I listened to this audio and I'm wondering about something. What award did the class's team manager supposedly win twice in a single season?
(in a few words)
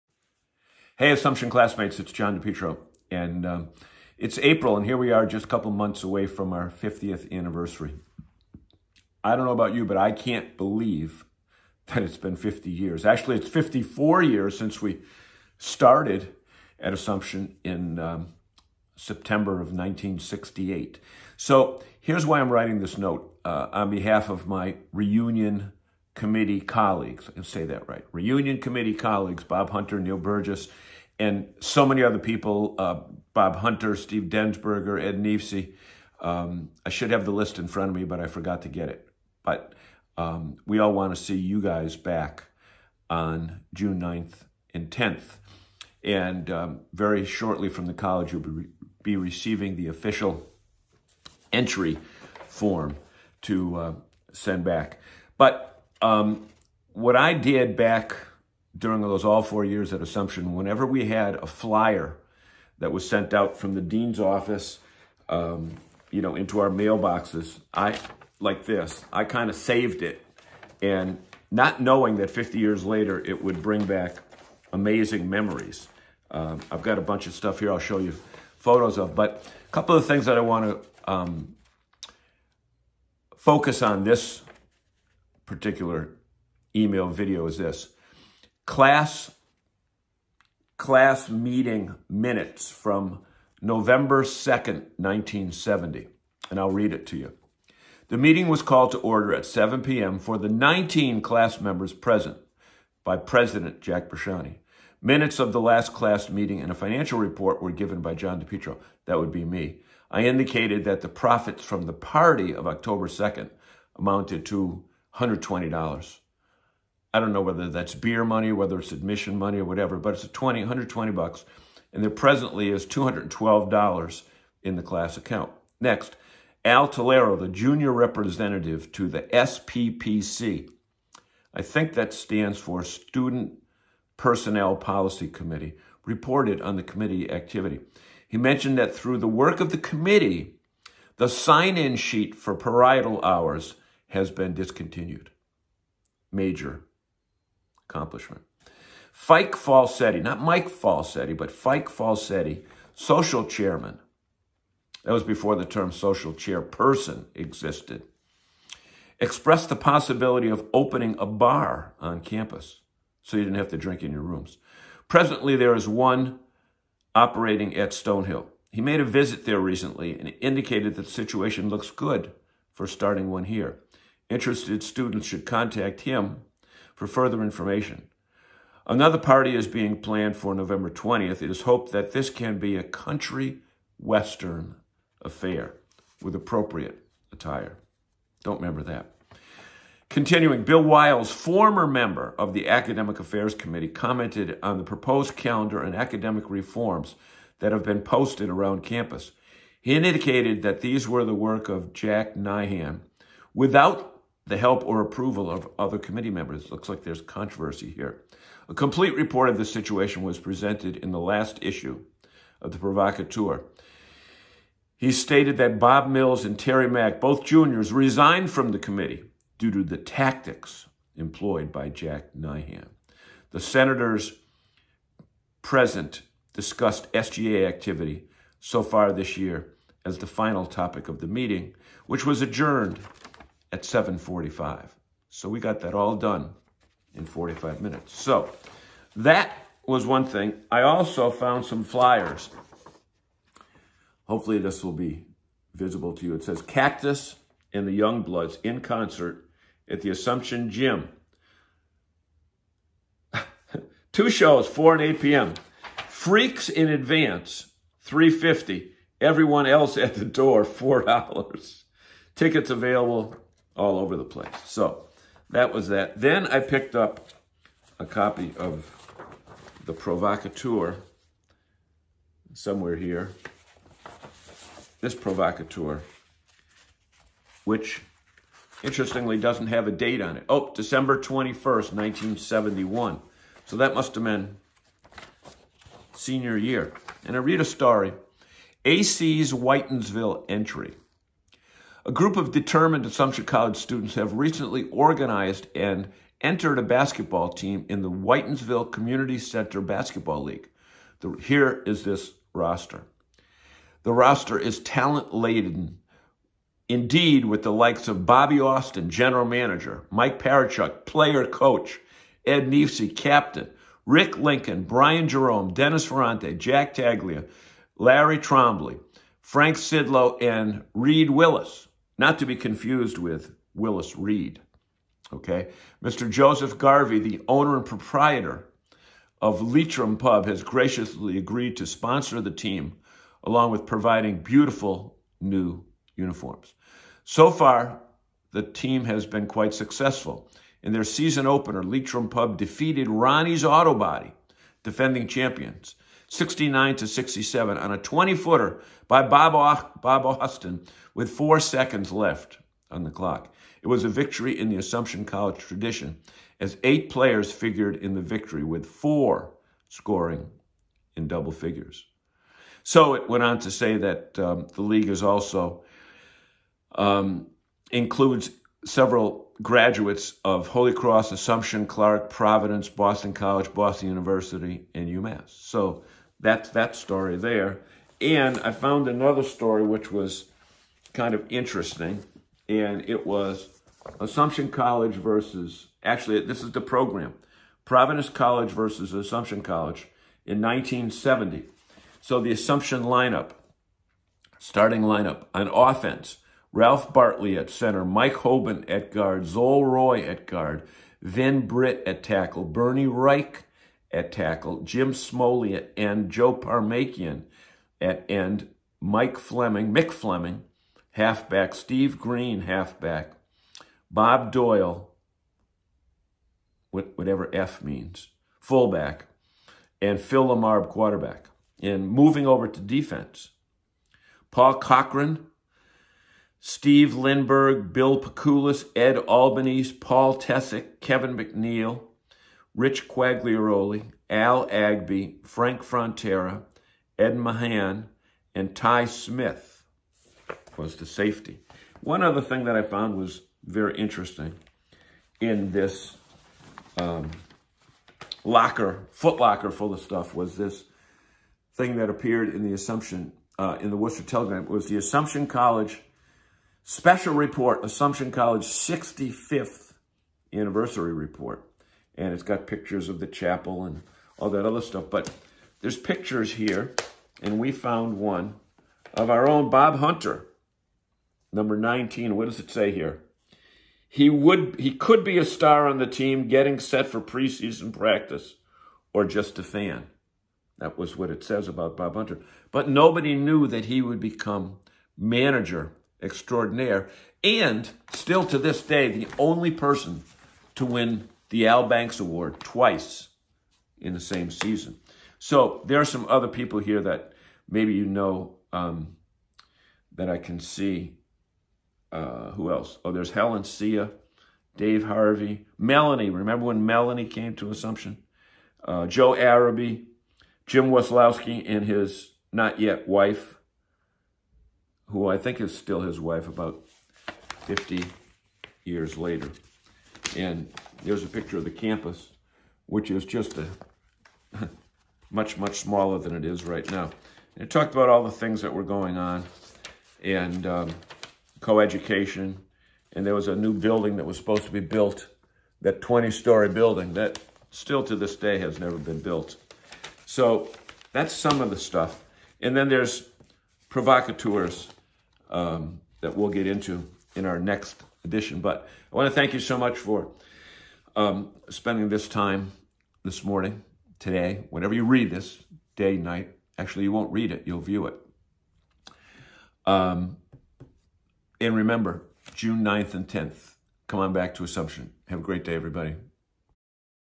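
Al Banks Award.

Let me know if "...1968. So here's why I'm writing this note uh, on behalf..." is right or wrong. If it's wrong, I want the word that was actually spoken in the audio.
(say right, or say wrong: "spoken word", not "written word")
right.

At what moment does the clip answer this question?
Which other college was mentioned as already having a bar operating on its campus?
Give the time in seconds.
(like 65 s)
167 s.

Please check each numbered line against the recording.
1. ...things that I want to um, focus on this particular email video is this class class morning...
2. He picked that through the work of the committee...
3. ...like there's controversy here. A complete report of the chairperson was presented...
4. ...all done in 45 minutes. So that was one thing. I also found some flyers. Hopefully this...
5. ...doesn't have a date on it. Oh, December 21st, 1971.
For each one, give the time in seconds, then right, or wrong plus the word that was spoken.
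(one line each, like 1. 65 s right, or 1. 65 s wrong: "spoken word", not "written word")
1. 80 s wrong: "meeting", not "morning"
2. 138 s wrong: "mentioned", not "picked"
3. 206 s wrong: "situation", not "chairperson"
4. 235 s right
5. 279 s right.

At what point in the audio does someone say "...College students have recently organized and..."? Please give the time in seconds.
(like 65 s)
293 s.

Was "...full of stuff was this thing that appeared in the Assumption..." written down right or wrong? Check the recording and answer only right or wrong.
right.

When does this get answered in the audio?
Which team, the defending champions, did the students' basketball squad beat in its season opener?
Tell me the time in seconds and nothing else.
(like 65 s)
343 s.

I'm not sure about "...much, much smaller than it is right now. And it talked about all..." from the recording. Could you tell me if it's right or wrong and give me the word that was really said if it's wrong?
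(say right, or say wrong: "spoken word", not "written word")
right.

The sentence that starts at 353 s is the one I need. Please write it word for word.
It was a victory in the Assumption College tradition as eight players figured in the victory with four scoring in double figures.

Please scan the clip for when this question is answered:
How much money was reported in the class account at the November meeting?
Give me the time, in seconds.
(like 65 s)
122 s.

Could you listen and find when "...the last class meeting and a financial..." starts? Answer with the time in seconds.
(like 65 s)
105 s.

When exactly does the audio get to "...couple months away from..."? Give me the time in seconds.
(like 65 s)
5 s.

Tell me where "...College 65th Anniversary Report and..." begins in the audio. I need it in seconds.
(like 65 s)
458 s.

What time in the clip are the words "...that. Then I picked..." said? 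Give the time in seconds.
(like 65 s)
265 s.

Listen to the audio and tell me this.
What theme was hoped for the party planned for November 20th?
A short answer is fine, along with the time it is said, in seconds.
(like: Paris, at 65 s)
country western, at 182 s.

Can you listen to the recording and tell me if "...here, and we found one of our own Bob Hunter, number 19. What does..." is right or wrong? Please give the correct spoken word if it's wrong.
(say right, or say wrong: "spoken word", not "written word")
right.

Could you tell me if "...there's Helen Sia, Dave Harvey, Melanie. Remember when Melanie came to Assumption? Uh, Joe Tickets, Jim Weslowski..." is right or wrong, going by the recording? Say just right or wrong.
wrong.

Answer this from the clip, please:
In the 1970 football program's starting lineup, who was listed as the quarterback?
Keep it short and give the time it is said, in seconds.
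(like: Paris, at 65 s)
Phil Lamarb, at 420 s.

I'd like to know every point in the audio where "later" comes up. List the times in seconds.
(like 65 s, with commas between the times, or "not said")
72 s, 519 s.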